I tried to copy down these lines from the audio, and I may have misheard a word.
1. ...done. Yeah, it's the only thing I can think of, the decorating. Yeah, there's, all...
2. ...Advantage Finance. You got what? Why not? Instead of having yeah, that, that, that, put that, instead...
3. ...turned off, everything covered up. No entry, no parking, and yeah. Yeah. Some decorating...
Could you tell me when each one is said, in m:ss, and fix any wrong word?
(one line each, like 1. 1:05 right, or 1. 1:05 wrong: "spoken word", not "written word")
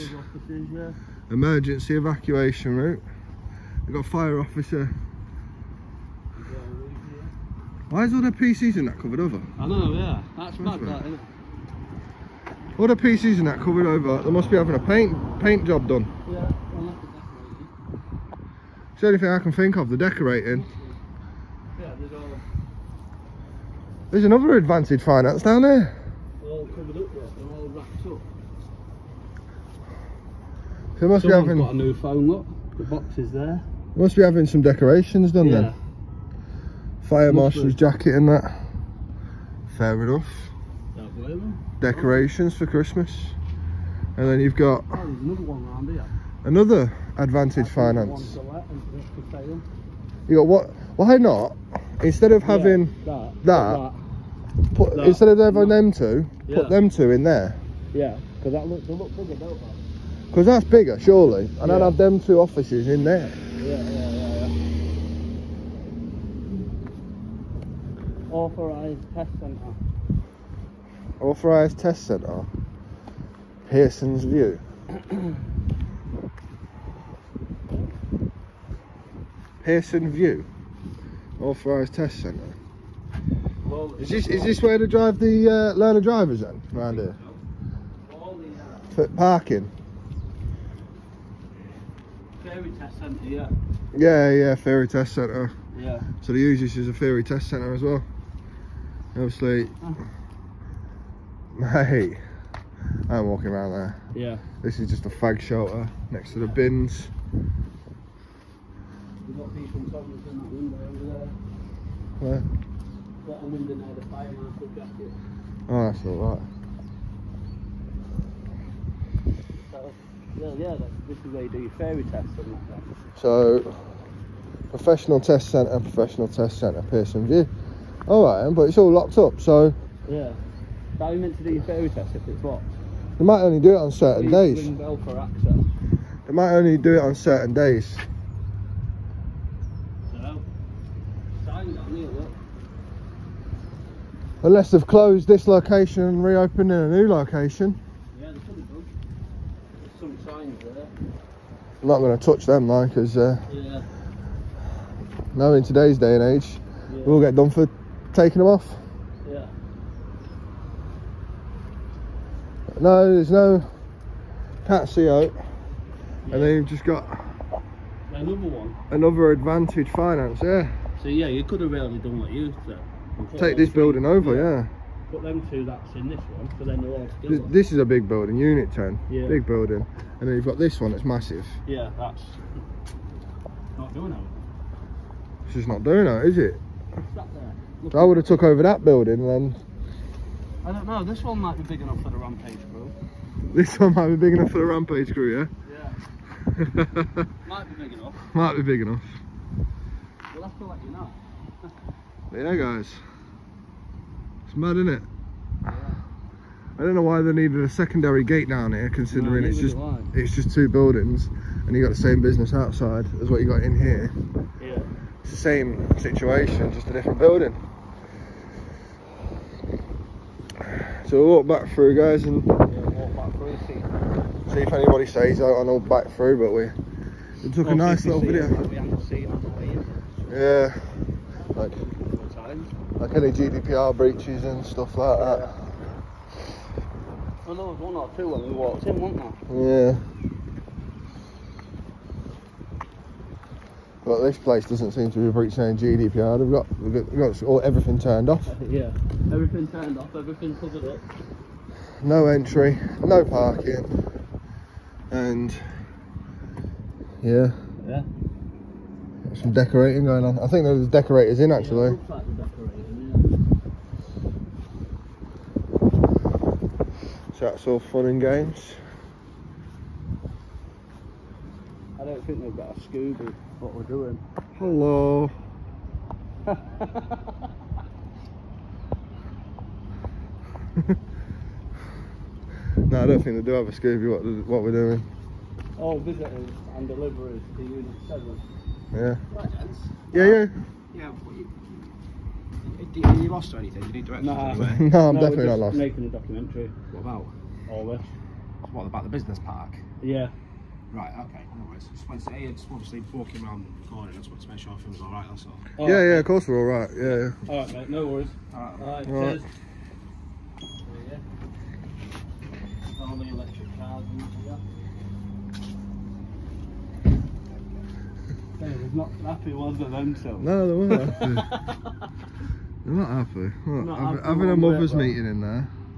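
1. 0:15 right
2. 0:47 right
3. 4:09 right.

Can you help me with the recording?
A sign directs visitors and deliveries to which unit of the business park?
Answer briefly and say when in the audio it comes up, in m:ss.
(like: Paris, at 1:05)
Unit 7, at 4:47.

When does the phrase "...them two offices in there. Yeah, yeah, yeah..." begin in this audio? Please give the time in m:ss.
1:01.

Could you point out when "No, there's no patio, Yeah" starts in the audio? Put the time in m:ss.
2:42.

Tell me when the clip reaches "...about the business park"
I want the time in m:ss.
4:58.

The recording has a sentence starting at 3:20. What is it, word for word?
We'll have to let you know.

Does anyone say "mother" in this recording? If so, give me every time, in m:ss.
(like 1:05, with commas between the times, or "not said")
5:24.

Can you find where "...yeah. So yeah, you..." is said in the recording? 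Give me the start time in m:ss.
2:50.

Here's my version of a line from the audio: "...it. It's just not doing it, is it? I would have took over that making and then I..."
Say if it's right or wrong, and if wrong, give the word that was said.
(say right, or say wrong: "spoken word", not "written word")
wrong: "building", not "making".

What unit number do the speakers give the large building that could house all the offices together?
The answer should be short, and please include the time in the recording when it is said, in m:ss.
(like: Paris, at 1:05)
Unit 10, at 2:58.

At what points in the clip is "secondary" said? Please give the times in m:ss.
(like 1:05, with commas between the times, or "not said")
3:27.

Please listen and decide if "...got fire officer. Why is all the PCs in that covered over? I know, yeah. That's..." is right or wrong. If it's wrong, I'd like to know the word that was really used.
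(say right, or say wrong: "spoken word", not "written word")
right.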